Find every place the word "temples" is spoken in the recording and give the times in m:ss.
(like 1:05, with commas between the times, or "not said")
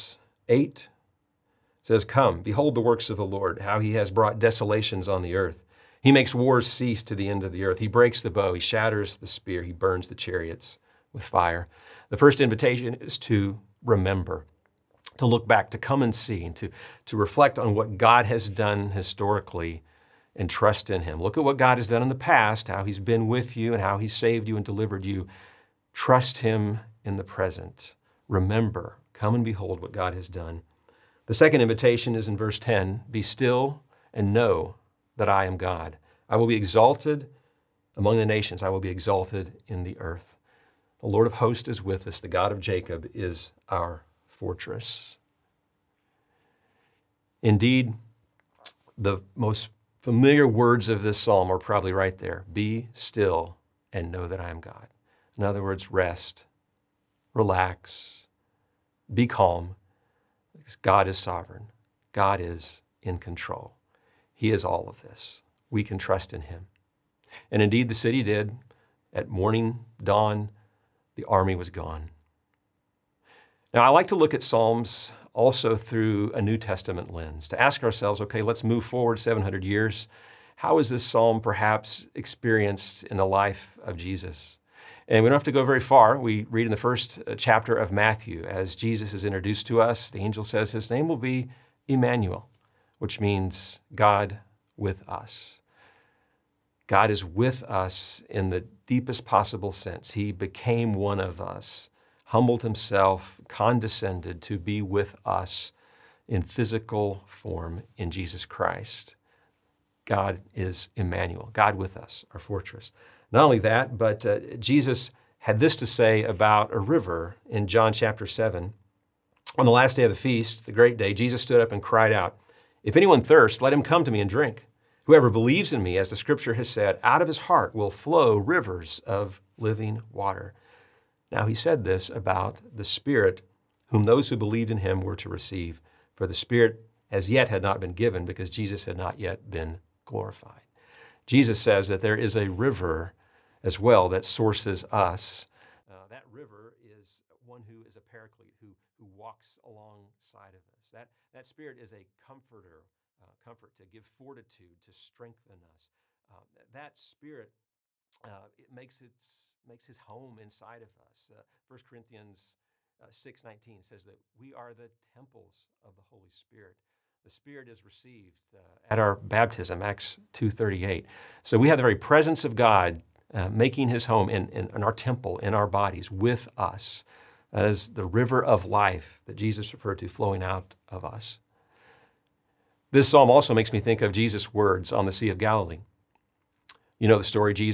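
2:44, 2:54.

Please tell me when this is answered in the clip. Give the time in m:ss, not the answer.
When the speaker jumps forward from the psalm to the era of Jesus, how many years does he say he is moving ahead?
1:19.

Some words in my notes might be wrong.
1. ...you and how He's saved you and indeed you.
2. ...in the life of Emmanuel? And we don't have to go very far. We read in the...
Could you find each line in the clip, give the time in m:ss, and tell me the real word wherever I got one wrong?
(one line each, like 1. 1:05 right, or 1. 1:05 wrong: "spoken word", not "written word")
1. 0:23 wrong: "delivered", not "indeed"
2. 1:23 wrong: "Jesus", not "Emmanuel".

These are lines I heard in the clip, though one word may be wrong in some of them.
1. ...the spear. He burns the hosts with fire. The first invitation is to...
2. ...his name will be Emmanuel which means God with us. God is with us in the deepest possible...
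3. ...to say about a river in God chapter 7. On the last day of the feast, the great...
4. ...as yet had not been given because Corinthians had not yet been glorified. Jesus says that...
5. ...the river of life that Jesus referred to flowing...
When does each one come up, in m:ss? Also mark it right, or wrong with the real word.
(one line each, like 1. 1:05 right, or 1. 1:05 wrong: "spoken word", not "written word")
1. 0:09 wrong: "chariots", not "hosts"
2. 1:30 right
3. 1:55 wrong: "John", not "God"
4. 2:17 wrong: "Jesus", not "Corinthians"
5. 2:57 right.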